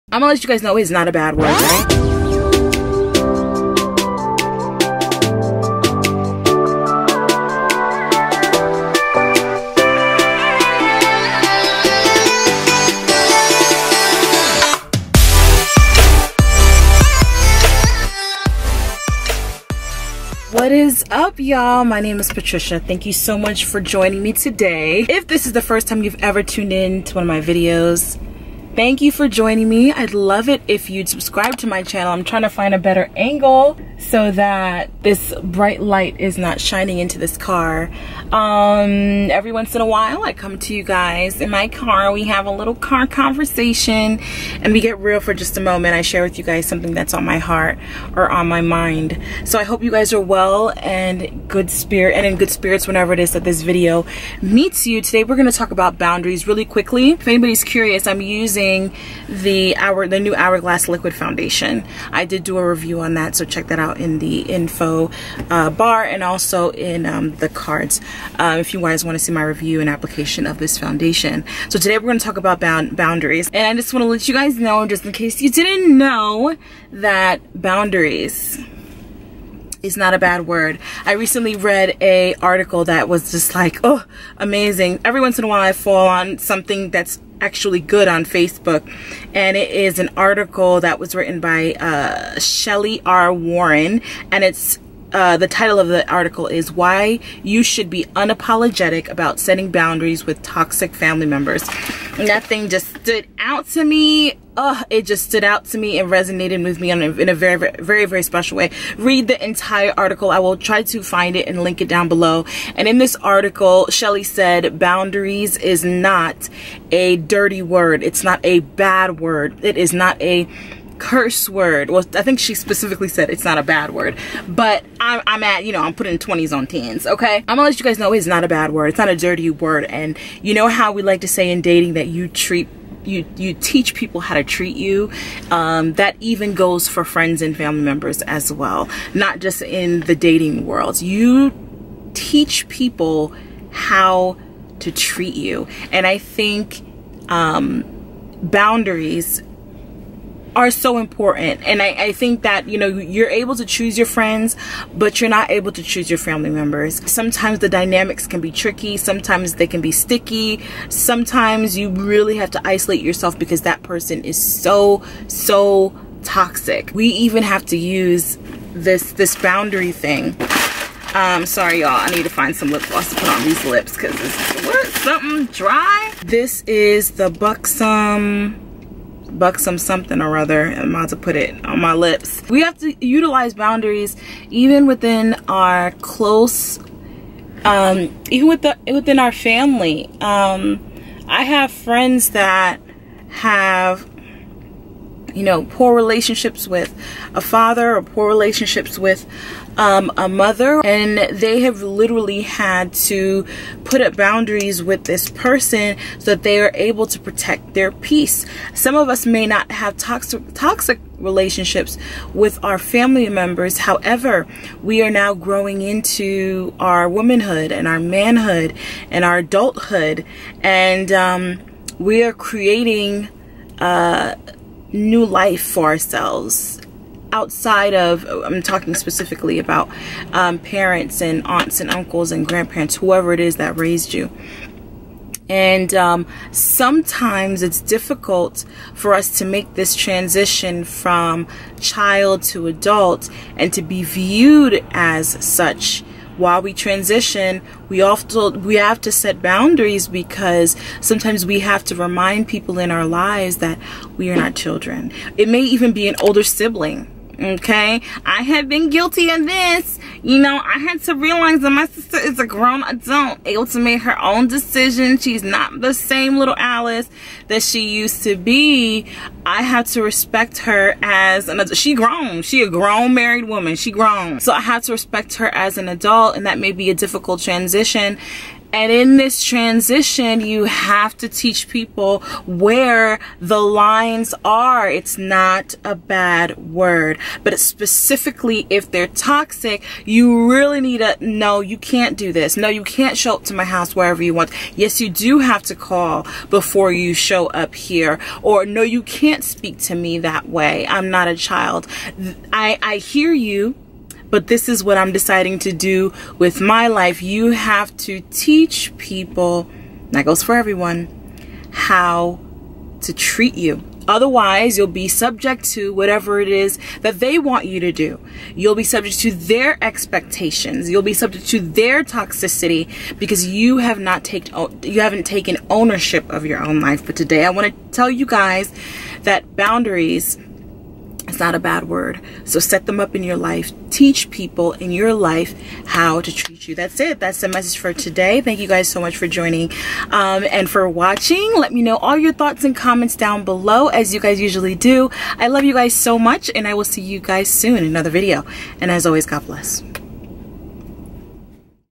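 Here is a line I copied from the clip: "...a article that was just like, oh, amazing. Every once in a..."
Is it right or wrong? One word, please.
right.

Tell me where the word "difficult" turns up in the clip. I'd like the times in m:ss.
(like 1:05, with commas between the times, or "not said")
3:57, 4:36.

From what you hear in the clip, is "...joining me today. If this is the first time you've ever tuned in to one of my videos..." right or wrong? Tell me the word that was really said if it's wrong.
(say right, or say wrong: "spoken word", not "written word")
right.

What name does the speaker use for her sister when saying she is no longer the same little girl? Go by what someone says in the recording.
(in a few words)
Alice.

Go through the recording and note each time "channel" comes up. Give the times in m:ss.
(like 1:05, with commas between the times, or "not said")
0:31.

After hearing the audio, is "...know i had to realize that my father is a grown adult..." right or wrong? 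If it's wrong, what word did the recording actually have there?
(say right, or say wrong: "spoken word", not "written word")
wrong: "sister", not "father".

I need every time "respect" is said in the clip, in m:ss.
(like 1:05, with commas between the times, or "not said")
4:30, 4:34.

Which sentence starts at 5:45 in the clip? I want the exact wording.
I love you guys so much and I will see you guys soon in another video.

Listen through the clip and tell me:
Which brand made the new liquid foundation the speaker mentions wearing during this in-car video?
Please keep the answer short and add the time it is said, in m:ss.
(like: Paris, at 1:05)
Hourglass, at 1:00.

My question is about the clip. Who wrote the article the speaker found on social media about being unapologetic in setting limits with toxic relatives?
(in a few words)
Shelly R. Warren.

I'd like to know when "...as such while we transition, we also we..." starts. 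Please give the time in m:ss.
4:04.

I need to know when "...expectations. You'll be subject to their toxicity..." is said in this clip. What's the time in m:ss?
5:19.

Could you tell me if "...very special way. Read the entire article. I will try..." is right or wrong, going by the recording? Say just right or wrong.
right.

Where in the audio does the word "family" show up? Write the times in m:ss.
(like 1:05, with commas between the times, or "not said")
1:40, 2:17, 2:36, 3:09, 3:32.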